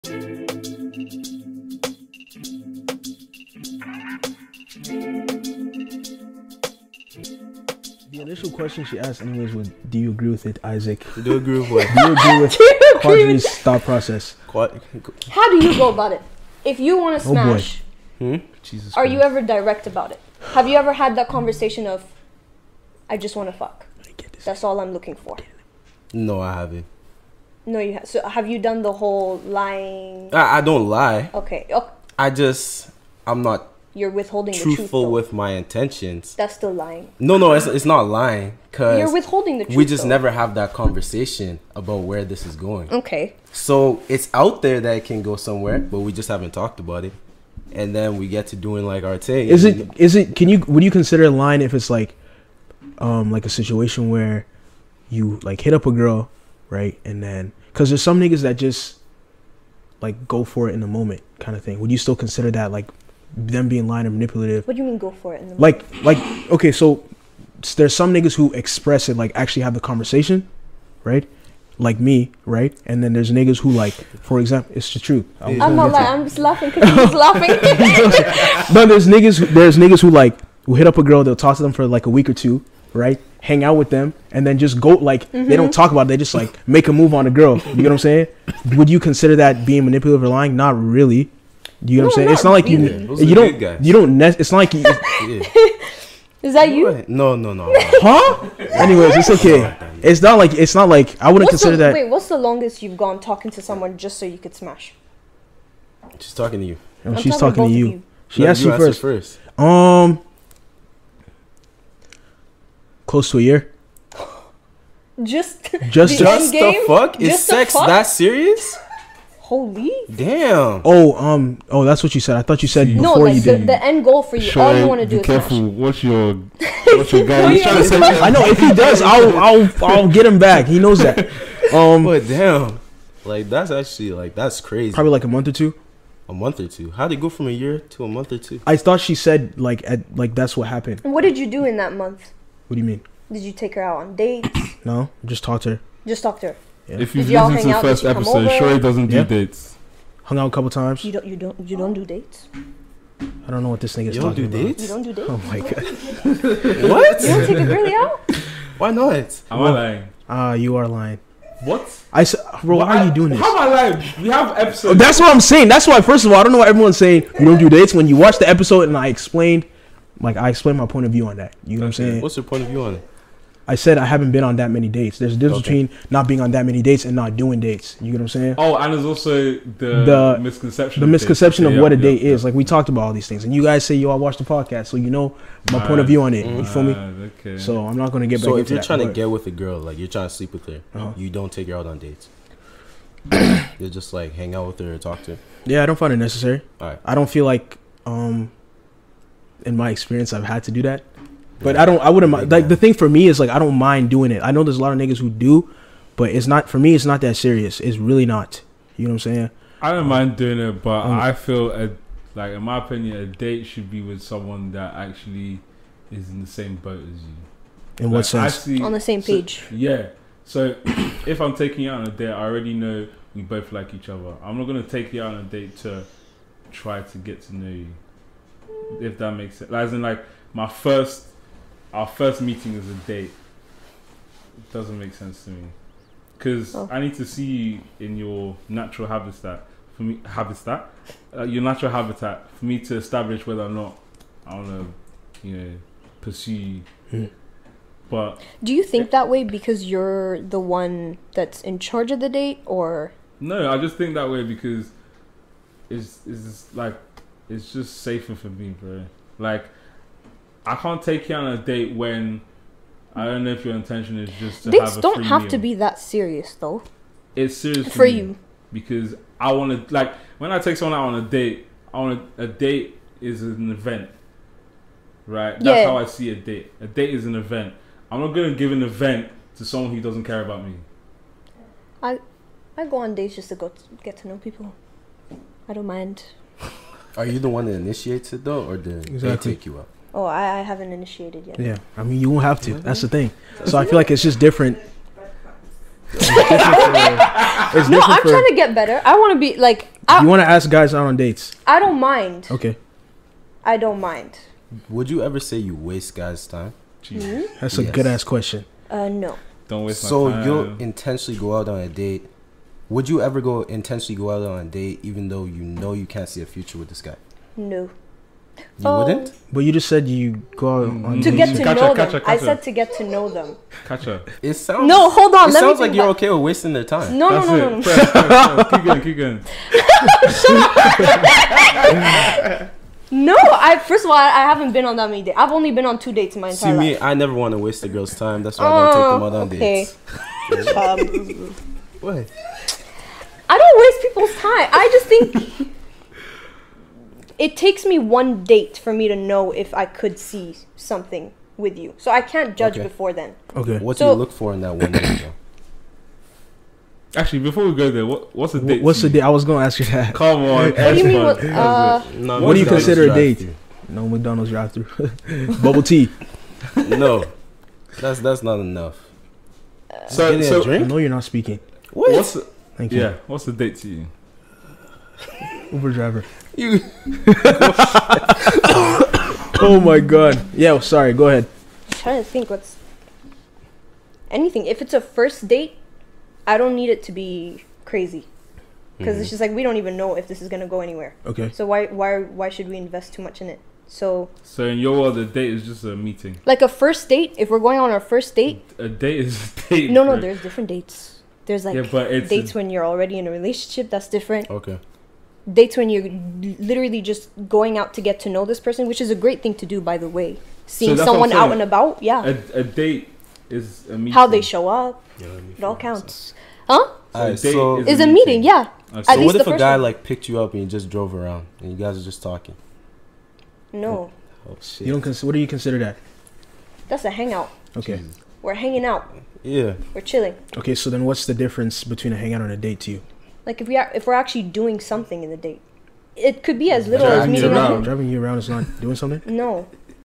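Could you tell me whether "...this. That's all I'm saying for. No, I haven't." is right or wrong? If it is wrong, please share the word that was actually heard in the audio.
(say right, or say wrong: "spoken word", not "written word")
wrong: "looking", not "saying".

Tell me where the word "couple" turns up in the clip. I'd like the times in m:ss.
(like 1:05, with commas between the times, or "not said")
2:30.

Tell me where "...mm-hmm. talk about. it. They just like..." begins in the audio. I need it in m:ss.
1:25.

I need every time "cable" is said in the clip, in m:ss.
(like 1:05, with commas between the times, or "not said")
not said.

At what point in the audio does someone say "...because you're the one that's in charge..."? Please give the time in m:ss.
4:09.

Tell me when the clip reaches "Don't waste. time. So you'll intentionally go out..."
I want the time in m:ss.
5:09.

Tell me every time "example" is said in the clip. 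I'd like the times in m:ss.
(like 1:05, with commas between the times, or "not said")
1:14.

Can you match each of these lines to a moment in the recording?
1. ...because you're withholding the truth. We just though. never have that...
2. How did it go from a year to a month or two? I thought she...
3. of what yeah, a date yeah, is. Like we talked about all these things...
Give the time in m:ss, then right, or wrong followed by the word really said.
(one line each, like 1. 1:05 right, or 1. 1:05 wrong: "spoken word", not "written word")
1. 0:38 right
2. 2:16 right
3. 3:01 right.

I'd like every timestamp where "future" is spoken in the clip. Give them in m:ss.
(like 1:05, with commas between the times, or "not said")
5:16.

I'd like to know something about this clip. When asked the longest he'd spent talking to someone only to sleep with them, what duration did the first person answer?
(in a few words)
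Close to a year.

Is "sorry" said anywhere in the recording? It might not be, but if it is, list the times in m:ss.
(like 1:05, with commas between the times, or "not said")
6:20.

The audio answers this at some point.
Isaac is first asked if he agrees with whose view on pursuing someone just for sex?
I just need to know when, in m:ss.
0:13.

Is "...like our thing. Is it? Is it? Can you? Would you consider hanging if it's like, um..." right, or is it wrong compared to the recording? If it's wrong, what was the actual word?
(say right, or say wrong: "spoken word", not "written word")
wrong: "lying", not "hanging".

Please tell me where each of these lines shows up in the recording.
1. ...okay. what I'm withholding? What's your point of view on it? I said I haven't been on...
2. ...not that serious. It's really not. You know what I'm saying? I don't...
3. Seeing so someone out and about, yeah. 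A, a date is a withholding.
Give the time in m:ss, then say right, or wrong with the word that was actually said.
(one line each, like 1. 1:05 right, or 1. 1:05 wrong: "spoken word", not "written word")
1. 2:51 wrong: "saying", not "withholding"
2. 3:27 right
3. 6:50 wrong: "meeting", not "withholding".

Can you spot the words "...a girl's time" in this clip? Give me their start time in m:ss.
5:37.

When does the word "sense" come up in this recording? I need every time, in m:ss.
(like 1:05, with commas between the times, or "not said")
3:38, 3:49, 3:55.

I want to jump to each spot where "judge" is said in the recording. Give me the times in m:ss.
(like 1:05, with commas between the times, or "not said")
5:52.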